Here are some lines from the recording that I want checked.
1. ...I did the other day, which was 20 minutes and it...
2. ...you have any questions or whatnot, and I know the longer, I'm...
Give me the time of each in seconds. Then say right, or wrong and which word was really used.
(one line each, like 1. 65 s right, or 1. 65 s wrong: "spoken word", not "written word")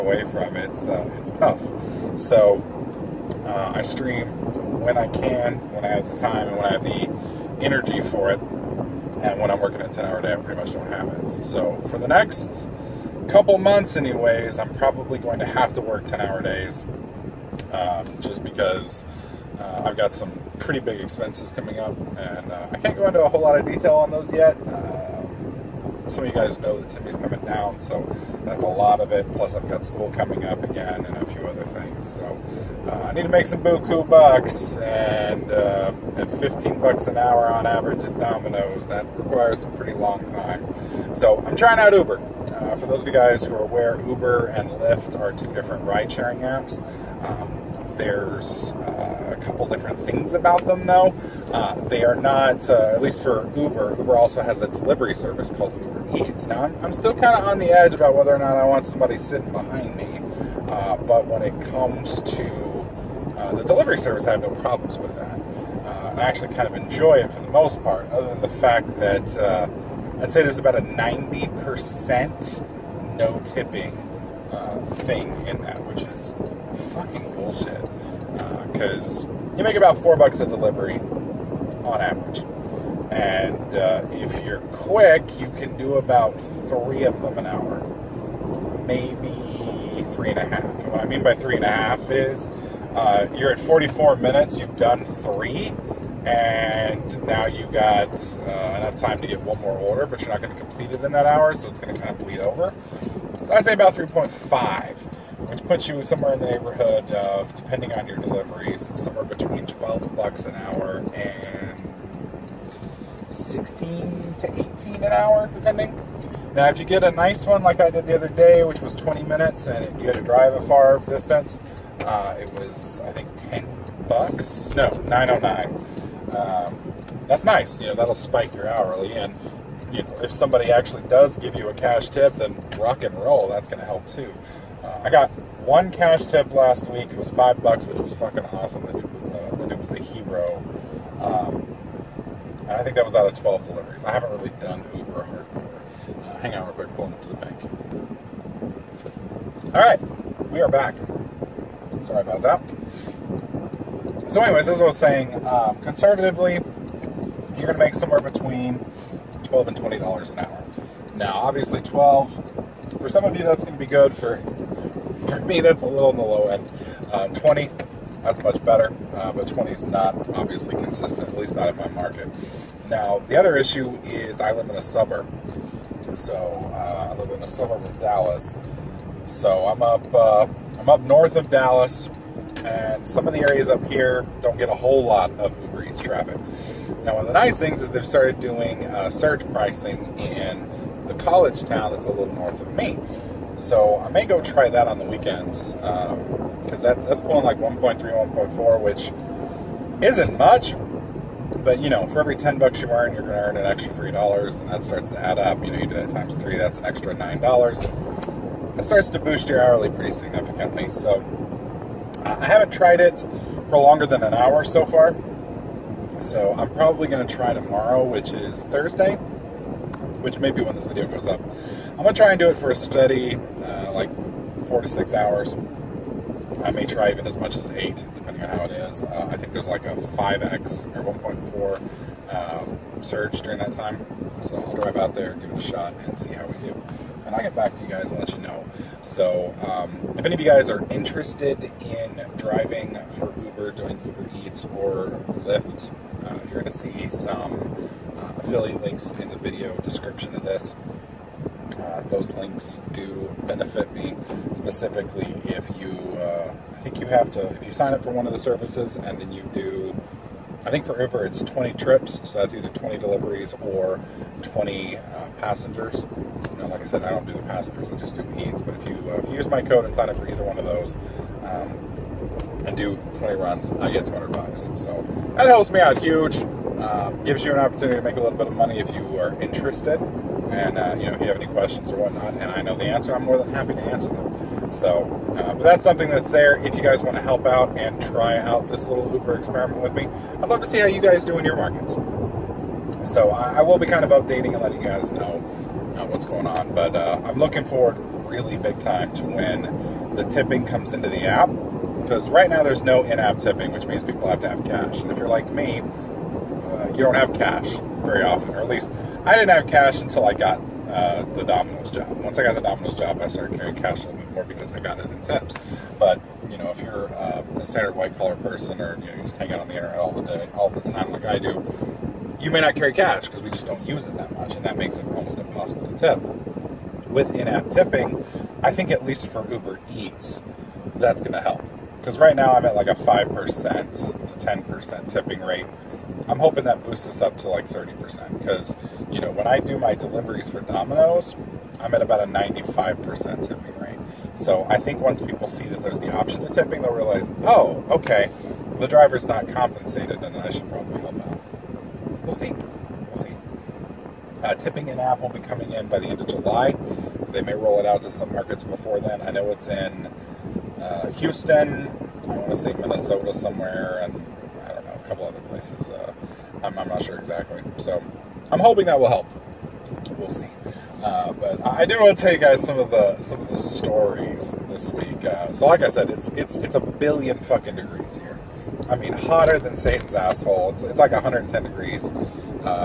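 1. 117 s right
2. 281 s wrong: "answer", not "longer".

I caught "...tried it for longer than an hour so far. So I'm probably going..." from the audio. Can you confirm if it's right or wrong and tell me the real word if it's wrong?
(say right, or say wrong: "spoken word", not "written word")
right.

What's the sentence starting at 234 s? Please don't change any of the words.
So I'll drive out there, give it a shot, and see how we do.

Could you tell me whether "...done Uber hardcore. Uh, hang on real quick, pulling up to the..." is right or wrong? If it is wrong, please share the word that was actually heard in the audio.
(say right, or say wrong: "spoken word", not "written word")
right.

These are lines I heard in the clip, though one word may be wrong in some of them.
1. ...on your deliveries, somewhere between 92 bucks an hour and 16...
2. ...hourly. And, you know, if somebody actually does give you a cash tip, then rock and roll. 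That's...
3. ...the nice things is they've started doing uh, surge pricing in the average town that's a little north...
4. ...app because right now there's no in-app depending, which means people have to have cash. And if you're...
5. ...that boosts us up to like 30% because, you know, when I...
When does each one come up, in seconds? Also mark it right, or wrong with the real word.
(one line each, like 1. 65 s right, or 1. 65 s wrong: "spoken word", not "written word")
1. 107 s wrong: "12", not "92"
2. 128 s right
3. 187 s wrong: "college", not "average"
4. 301 s wrong: "tipping", not "depending"
5. 336 s right.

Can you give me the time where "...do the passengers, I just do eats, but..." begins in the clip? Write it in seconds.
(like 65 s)
267 s.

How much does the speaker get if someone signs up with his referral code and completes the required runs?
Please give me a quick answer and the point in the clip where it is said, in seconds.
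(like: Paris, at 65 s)
$200, at 274 s.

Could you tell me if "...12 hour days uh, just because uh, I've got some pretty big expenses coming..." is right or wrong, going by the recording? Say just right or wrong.
wrong.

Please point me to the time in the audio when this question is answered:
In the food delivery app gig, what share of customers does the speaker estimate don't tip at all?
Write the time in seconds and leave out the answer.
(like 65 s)
70 s.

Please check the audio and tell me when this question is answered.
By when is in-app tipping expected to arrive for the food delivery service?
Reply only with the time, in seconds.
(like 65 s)
356 s.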